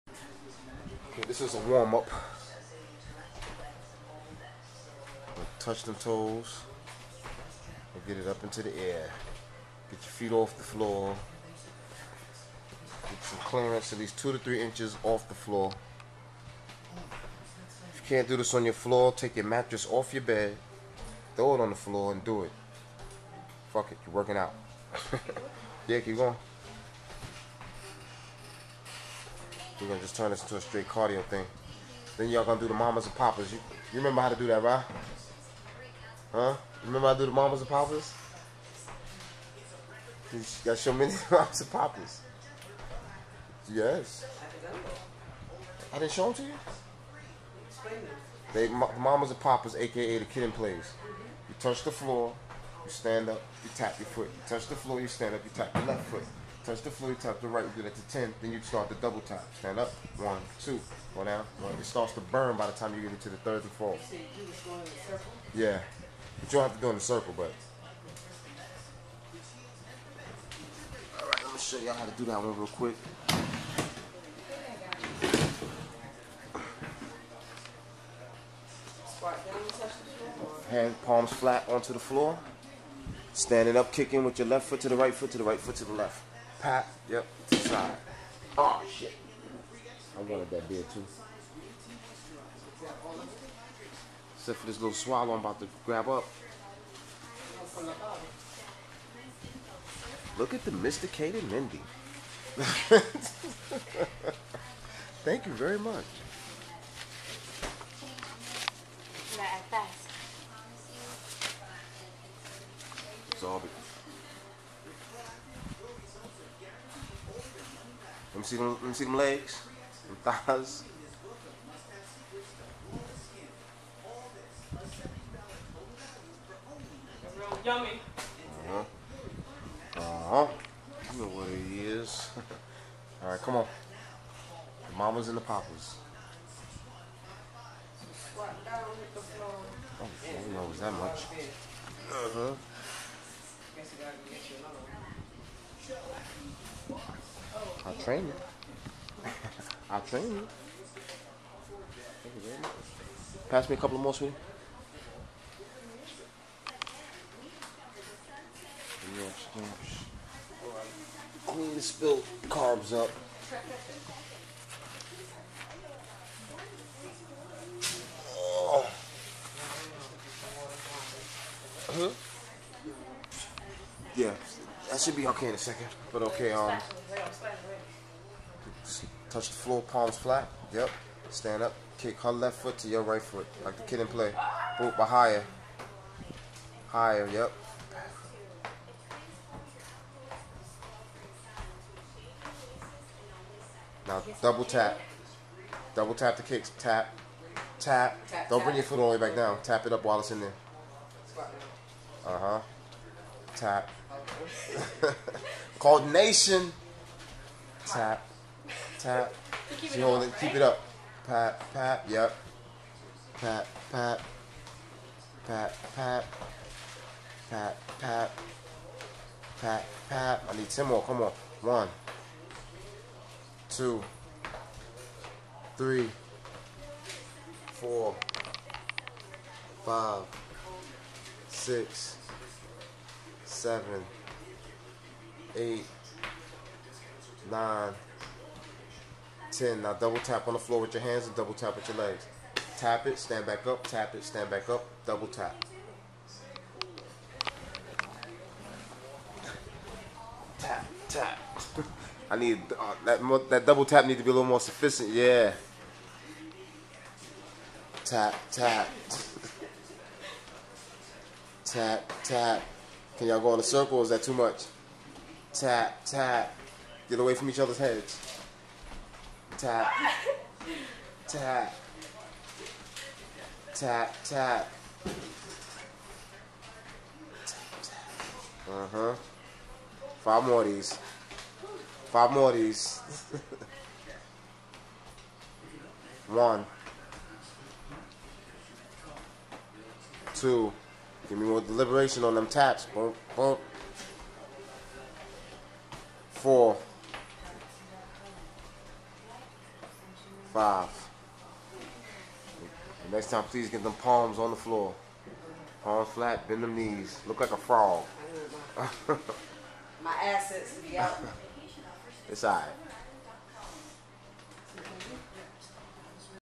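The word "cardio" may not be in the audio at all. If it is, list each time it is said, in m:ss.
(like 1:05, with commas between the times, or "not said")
0:30.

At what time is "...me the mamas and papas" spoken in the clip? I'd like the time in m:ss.
0:40.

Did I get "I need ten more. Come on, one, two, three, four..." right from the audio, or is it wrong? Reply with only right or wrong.
right.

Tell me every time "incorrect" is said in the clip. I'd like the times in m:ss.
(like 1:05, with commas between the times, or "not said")
not said.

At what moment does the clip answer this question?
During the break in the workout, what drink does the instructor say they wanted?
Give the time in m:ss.
1:30.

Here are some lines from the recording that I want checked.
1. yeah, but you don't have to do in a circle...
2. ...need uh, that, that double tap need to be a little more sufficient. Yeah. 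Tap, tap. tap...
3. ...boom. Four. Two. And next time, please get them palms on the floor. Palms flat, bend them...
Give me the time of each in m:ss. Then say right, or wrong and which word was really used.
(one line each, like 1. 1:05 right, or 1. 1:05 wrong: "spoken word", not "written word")
1. 1:05 right
2. 4:12 right
3. 4:53 wrong: "Five", not "Two".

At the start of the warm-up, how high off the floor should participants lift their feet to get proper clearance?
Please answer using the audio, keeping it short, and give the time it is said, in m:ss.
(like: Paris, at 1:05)
2 to 3 inches, at 0:14.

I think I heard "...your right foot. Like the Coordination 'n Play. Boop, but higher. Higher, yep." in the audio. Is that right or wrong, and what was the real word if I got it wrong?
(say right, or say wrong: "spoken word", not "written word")
wrong: "Kid", not "Coordination".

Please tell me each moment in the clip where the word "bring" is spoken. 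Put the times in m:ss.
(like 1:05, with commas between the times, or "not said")
3:18.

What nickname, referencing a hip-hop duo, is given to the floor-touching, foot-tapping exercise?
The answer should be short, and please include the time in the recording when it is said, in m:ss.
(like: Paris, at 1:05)
Kid 'n Plays, at 0:50.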